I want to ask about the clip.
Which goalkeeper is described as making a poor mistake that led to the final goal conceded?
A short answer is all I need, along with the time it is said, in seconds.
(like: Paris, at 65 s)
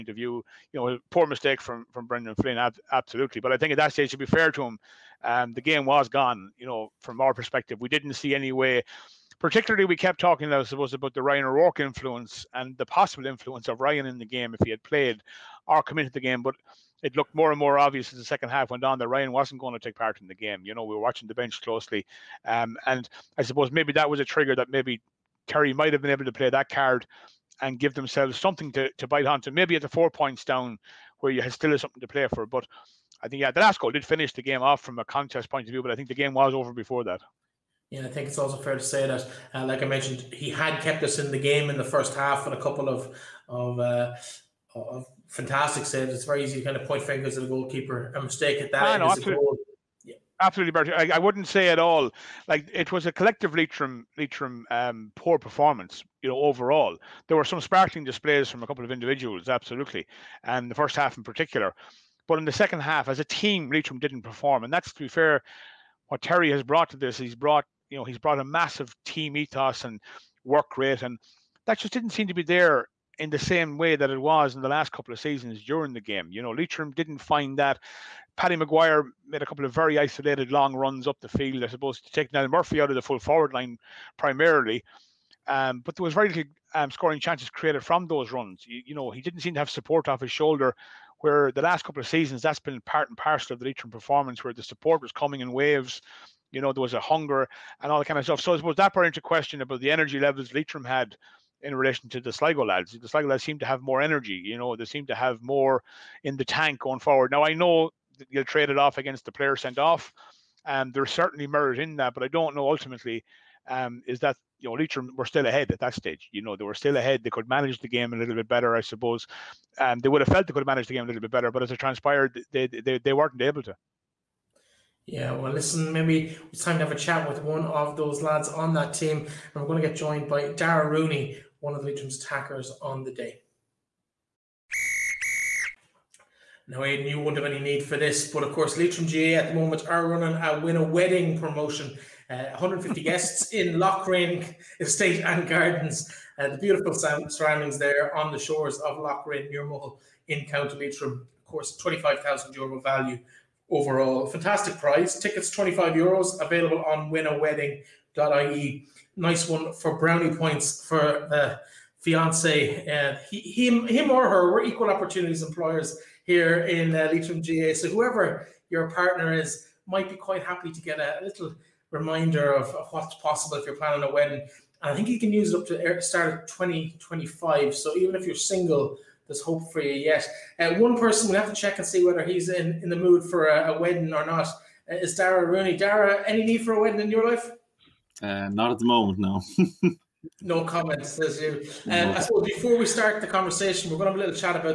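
Brendan Flynn, at 2 s.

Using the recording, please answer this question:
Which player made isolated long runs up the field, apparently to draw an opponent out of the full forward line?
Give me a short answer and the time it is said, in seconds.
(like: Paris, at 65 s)
Paddy McGuire, at 78 s.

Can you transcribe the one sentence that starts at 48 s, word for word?
A mistake at that no, absolutely Bertie.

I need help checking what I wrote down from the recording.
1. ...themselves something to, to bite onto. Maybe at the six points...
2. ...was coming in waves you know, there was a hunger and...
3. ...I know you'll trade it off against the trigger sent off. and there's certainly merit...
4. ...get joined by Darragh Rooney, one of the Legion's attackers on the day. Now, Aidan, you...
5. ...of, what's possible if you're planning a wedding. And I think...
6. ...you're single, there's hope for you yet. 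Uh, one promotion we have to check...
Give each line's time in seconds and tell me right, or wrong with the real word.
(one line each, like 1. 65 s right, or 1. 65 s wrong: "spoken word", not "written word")
1. 27 s wrong: "four", not "six"
2. 95 s right
3. 107 s wrong: "player", not "trigger"
4. 129 s right
5. 172 s right
6. 178 s wrong: "person", not "promotion".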